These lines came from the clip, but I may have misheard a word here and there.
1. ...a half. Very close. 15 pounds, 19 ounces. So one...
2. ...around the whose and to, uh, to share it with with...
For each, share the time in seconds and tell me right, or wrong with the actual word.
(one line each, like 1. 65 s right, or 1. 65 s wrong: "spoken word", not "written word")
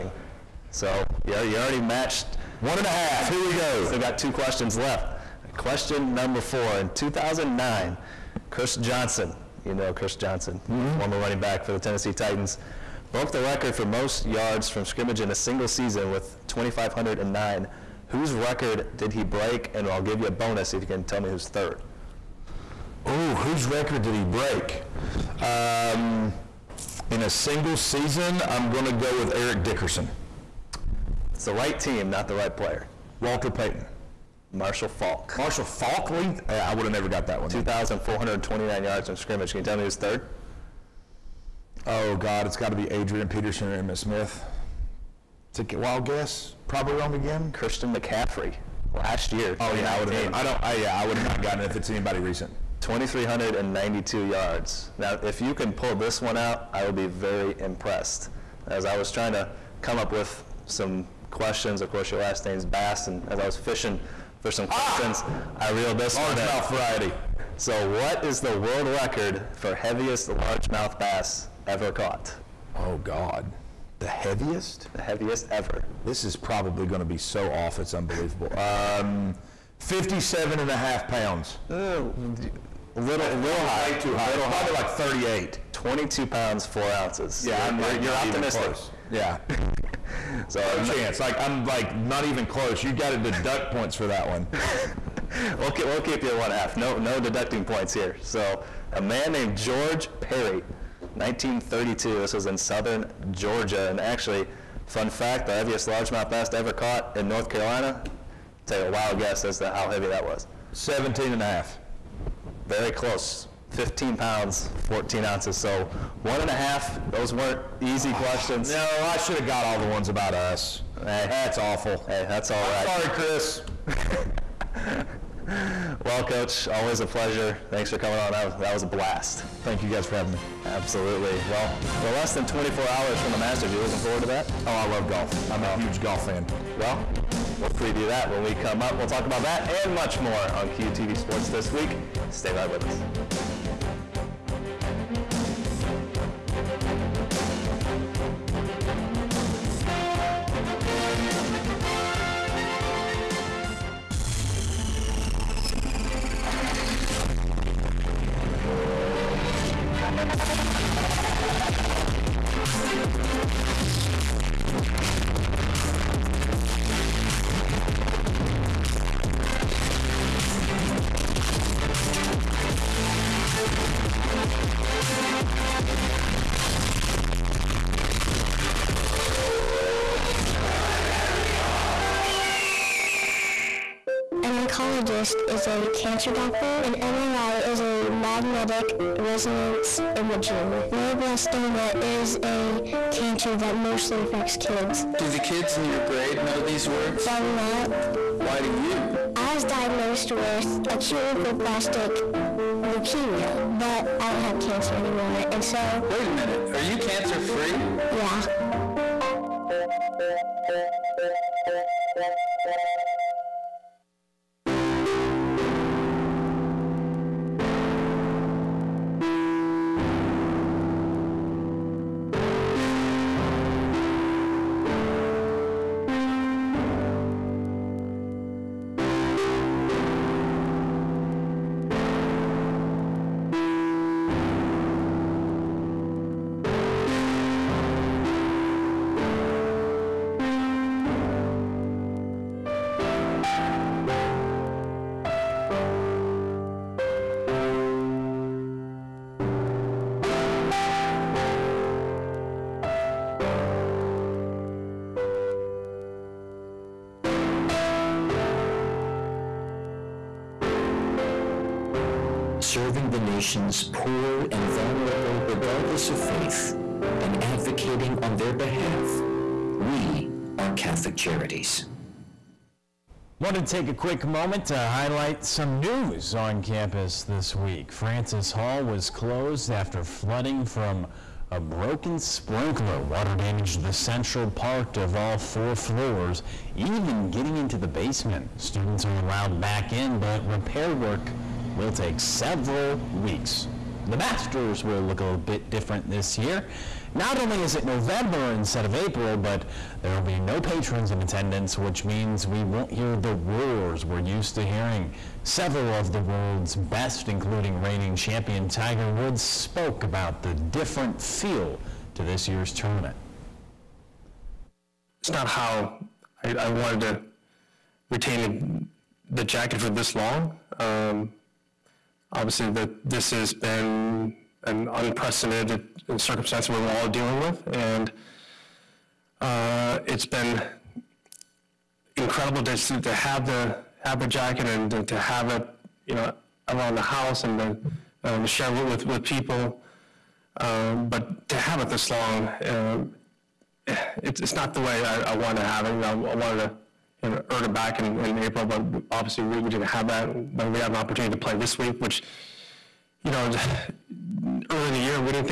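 1. 111 s wrong: "14", not "19"
2. 336 s wrong: "house", not "whose".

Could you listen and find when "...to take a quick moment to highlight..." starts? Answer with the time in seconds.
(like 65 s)
273 s.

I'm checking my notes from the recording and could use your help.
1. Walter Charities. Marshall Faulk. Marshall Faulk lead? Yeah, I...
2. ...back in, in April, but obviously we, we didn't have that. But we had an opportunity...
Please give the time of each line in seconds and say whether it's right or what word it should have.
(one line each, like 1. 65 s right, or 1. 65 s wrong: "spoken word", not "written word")
1. 33 s wrong: "Payton", not "Charities"
2. 347 s right.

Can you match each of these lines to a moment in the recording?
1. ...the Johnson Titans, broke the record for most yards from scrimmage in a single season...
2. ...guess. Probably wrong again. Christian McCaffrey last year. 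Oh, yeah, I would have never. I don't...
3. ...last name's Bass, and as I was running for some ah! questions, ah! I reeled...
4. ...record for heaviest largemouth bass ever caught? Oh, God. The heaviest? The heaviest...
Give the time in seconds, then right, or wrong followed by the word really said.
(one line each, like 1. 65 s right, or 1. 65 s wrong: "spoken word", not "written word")
1. 11 s wrong: "Tennessee", not "Johnson"
2. 46 s right
3. 62 s wrong: "fishing", not "running"
4. 68 s right.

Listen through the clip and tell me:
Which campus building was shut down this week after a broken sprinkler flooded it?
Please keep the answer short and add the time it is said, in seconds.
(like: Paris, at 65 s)
Francis Hall, at 277 s.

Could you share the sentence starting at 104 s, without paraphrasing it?
Fun fact, the heaviest largemouth bass ever caught in North Carolina.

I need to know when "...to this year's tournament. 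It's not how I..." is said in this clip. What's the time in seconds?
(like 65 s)
312 s.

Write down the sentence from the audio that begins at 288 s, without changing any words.
Students are allowed back in, but repair work will take several weeks.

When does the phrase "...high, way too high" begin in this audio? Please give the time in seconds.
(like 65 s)
83 s.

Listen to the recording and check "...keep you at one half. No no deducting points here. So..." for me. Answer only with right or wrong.
right.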